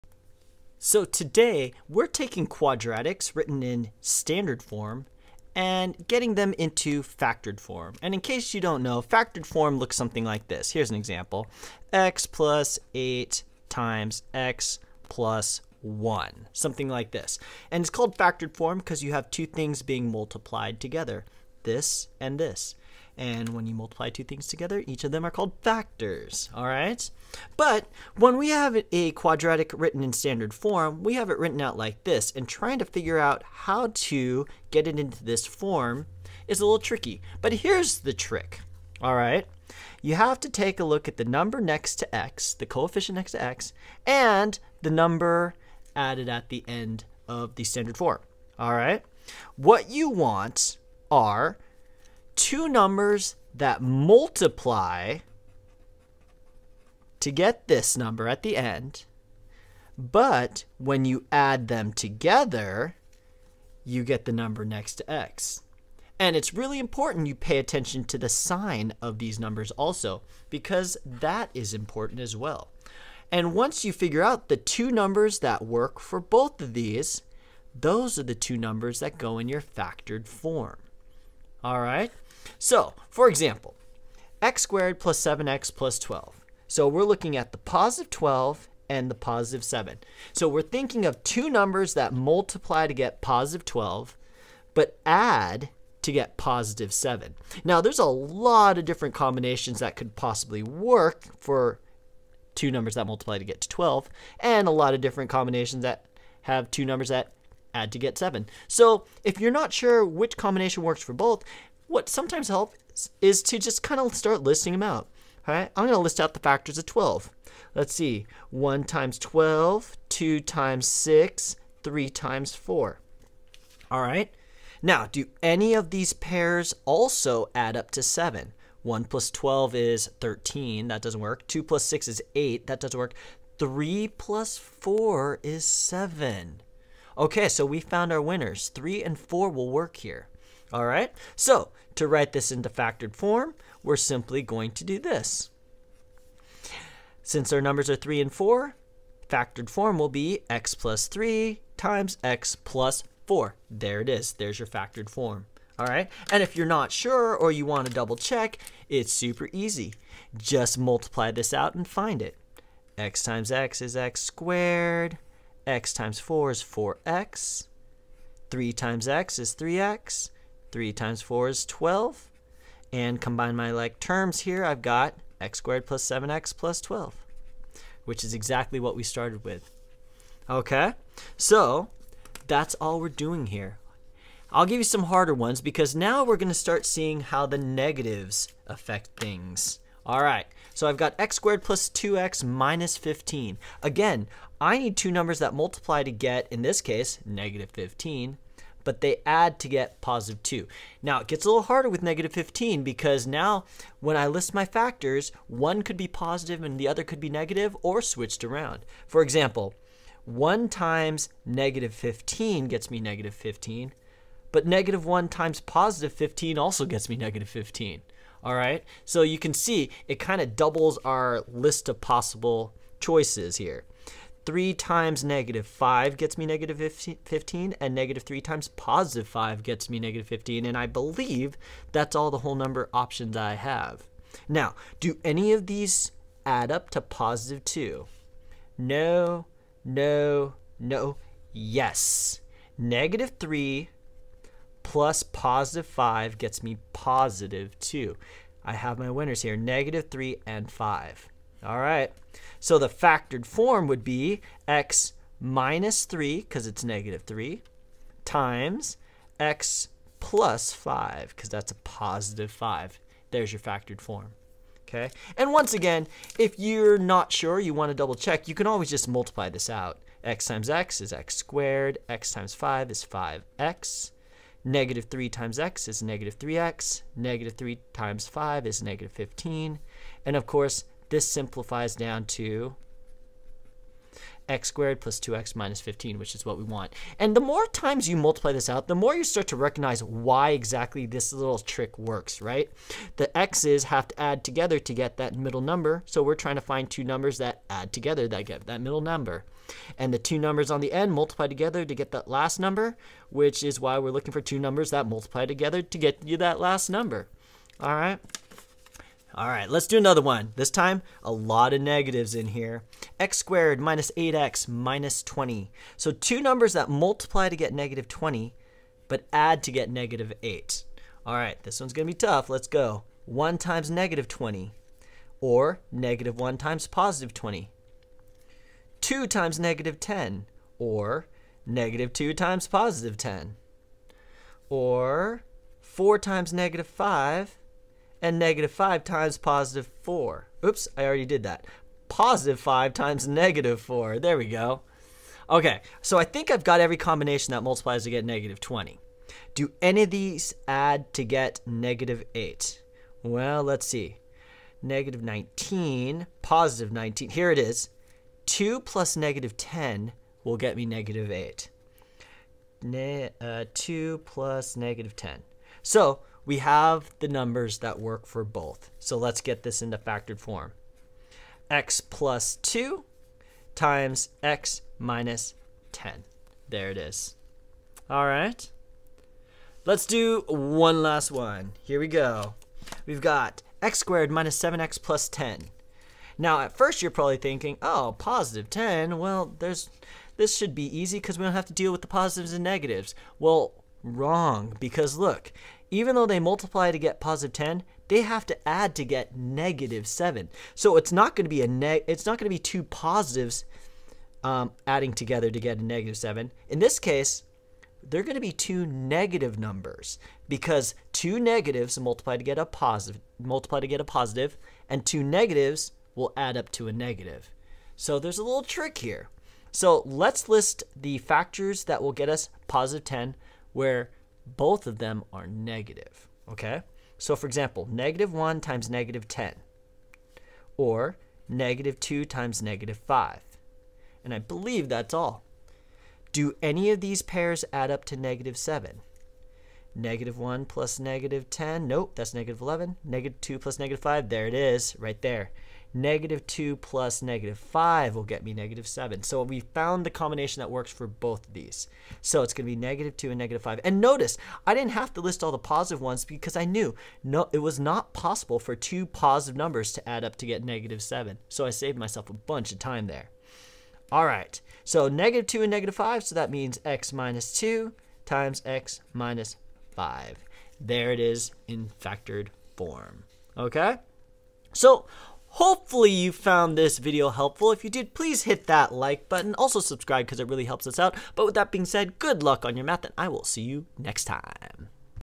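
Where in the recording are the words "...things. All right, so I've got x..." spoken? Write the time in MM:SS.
03:09.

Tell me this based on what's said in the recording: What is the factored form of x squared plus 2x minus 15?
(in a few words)
(x - 3)(x + 5).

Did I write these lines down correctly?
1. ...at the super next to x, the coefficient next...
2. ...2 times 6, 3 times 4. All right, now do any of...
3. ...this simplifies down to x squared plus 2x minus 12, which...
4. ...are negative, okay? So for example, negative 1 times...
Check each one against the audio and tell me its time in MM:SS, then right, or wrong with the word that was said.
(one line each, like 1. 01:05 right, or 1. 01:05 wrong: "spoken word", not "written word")
1. 00:41 wrong: "number", not "super"
2. 02:00 right
3. 04:41 wrong: "15", not "12"
4. 07:05 right.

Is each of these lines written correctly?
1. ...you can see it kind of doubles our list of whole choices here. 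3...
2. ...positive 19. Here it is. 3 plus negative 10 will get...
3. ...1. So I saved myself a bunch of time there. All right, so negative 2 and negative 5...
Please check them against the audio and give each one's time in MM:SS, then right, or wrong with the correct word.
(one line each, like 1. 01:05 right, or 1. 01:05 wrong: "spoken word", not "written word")
1. 03:39 wrong: "possible", not "whole"
2. 05:56 wrong: "2", not "3"
3. 07:41 wrong: "7", not "1".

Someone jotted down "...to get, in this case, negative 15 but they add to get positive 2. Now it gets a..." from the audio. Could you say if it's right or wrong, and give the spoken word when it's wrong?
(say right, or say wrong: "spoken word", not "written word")
right.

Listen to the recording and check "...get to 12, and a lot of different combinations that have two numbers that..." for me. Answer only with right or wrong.
right.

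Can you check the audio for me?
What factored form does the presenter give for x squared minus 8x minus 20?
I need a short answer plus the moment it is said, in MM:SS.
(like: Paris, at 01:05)
(x + 2)(x - 10), at 06:11.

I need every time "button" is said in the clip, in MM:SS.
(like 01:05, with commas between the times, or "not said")
07:59.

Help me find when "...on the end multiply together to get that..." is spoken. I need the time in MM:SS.
05:00.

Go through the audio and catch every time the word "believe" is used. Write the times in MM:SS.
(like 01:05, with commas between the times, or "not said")
03:50, 07:14.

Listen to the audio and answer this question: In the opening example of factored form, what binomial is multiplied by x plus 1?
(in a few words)
x + 8.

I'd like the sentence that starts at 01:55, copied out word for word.
All right, I'm going to list out the factors of 12.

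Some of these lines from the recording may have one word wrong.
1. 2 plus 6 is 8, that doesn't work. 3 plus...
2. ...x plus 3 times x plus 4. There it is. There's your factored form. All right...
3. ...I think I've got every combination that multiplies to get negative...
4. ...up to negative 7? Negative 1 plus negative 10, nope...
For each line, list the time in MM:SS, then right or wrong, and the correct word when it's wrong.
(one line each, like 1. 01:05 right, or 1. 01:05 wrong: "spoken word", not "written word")
1. 02:11 right
2. 02:30 right
3. 05:46 right
4. 07:17 right.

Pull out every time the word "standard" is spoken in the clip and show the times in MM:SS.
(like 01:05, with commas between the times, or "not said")
00:04, 00:30, 00:47.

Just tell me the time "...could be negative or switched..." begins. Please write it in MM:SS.
03:27.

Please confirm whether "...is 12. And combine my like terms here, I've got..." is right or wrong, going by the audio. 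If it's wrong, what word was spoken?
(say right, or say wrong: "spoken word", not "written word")
right.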